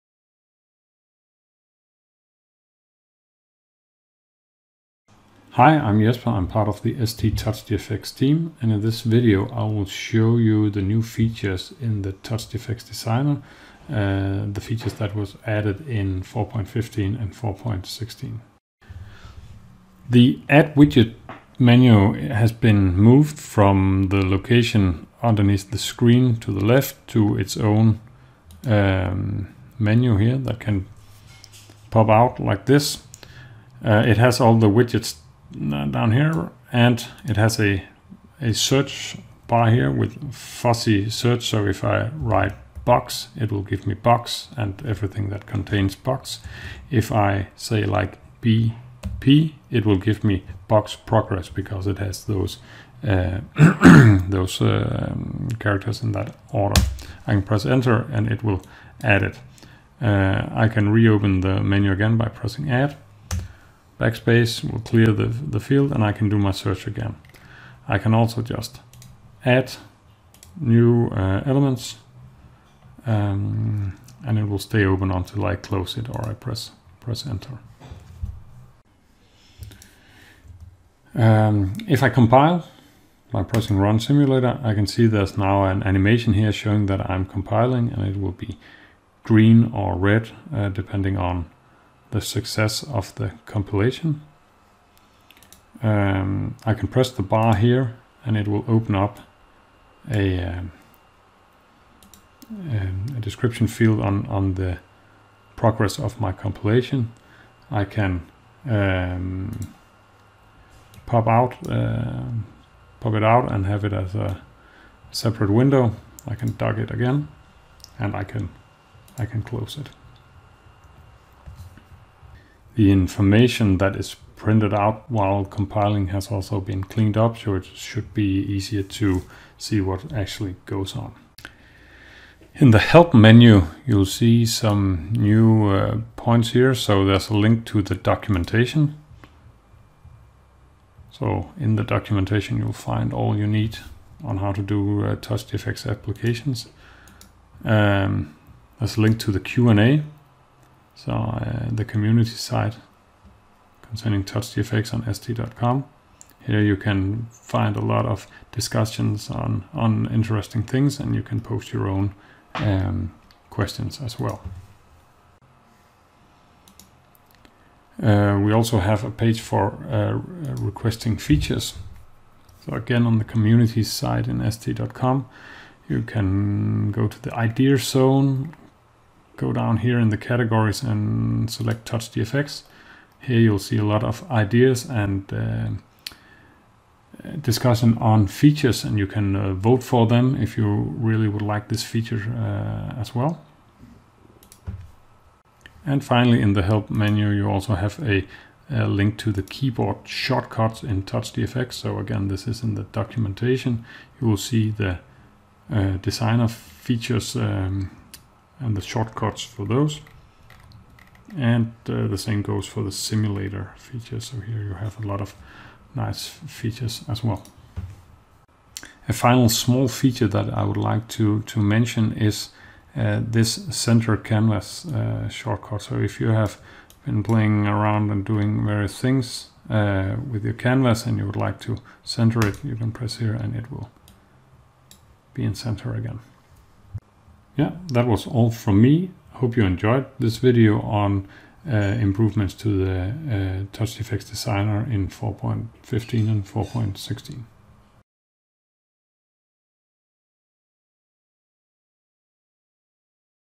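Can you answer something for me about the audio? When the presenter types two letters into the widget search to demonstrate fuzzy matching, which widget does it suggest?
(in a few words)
Box progress.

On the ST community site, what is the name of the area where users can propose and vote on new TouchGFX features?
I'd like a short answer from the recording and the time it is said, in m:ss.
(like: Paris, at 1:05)
Idea zone, at 2:57.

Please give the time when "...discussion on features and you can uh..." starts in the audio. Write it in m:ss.
3:07.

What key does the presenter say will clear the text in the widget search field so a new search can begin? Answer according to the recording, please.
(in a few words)
Backspace.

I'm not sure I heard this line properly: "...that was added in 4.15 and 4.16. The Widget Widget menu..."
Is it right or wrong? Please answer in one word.
wrong.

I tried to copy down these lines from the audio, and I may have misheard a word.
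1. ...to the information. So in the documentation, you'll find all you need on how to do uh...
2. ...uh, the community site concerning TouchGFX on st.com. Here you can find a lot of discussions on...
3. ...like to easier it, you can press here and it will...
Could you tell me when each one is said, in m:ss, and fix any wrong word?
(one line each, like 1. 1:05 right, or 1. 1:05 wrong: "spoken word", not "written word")
1. 2:17 wrong: "documentation", not "information"
2. 2:31 right
3. 3:51 wrong: "center", not "easier".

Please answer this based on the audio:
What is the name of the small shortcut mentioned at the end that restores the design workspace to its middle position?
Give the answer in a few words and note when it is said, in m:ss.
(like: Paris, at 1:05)
Center canvas, at 3:43.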